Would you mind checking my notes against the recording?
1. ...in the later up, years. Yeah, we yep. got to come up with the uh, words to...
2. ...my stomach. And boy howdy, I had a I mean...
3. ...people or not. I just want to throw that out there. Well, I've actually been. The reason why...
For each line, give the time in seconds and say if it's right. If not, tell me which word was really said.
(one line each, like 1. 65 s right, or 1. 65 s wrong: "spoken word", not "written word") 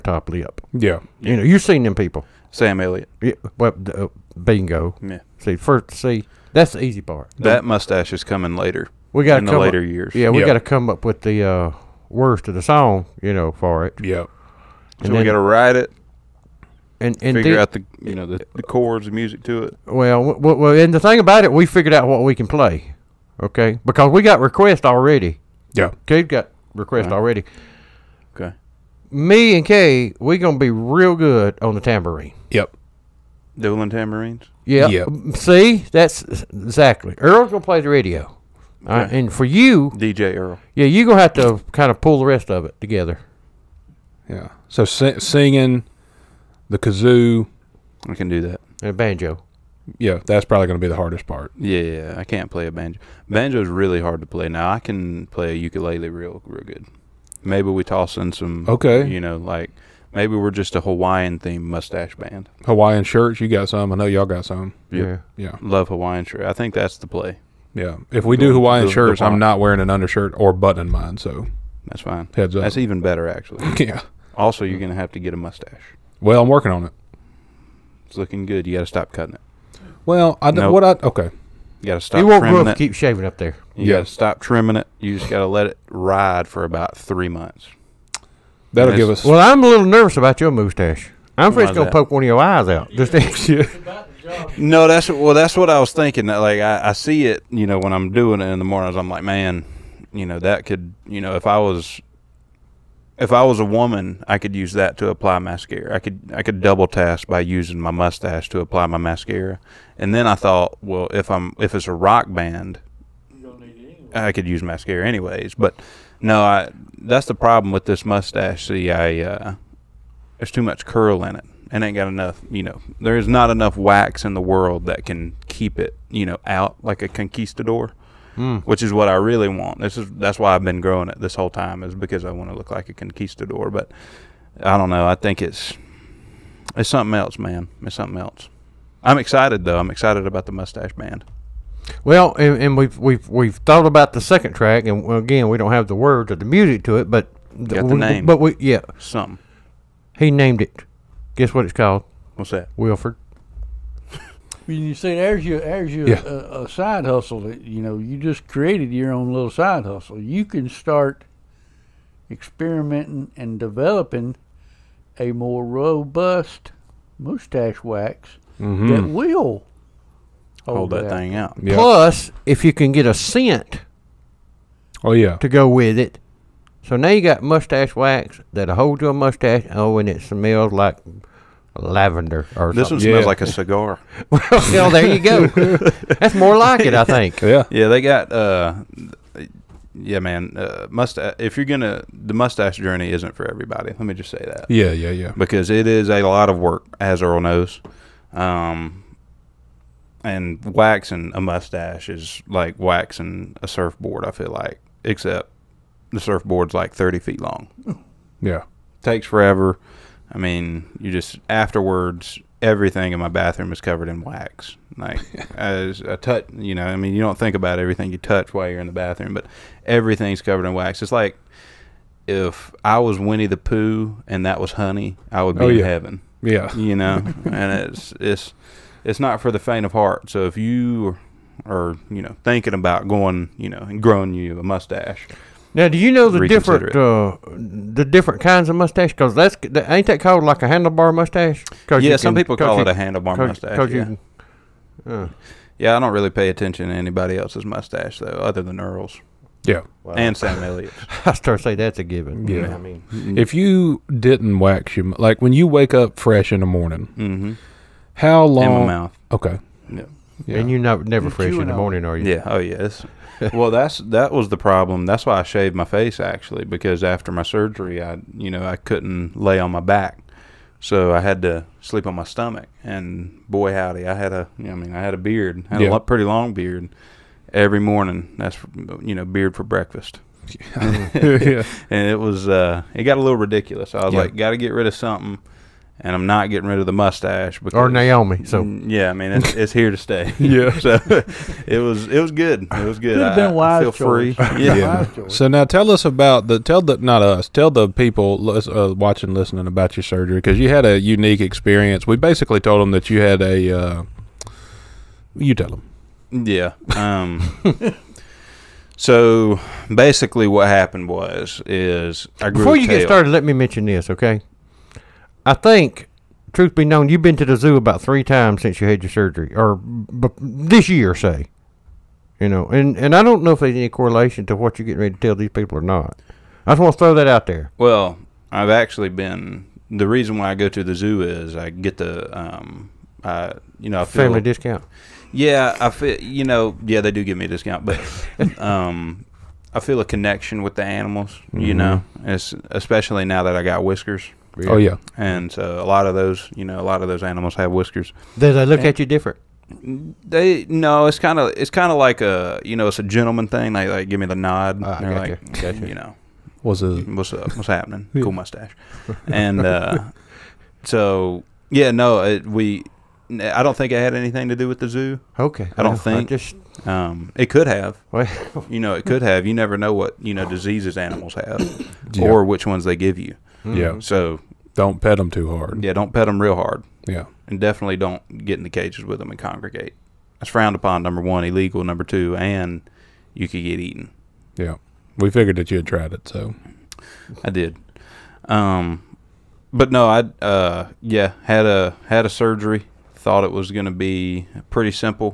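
1. 9 s right
2. 272 s right
3. 325 s right.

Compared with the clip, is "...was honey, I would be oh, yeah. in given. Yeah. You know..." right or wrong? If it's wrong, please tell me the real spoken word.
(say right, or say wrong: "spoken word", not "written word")
wrong: "heaven", not "given".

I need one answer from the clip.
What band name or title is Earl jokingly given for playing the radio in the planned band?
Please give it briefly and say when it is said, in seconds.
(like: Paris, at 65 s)
DJ Earl, at 39 s.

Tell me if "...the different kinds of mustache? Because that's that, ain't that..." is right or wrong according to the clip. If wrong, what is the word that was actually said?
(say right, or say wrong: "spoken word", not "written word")
right.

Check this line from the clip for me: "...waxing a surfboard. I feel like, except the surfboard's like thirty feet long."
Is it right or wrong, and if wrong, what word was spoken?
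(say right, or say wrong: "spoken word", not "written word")
right.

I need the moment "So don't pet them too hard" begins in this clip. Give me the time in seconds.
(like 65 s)
374 s.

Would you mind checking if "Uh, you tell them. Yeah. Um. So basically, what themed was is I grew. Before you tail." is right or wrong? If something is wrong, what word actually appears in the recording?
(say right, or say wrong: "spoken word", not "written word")
wrong: "happened", not "themed".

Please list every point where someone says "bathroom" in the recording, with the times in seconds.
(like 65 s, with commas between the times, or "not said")
213 s, 218 s.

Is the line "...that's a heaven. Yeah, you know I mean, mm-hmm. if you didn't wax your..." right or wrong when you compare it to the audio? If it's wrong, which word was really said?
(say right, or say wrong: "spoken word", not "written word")
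wrong: "given", not "heaven".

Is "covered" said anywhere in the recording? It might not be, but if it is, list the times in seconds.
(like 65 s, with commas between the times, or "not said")
213 s, 220 s.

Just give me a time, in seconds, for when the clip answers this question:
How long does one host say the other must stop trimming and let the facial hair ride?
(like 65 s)
86 s.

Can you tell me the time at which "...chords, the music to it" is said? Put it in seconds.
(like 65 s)
18 s.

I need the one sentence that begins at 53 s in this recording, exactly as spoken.
Banjo is really hard to play.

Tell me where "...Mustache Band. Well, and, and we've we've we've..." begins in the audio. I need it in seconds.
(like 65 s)
140 s.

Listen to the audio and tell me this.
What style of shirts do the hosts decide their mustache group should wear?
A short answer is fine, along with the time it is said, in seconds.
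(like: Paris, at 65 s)
Hawaiian shirts, at 62 s.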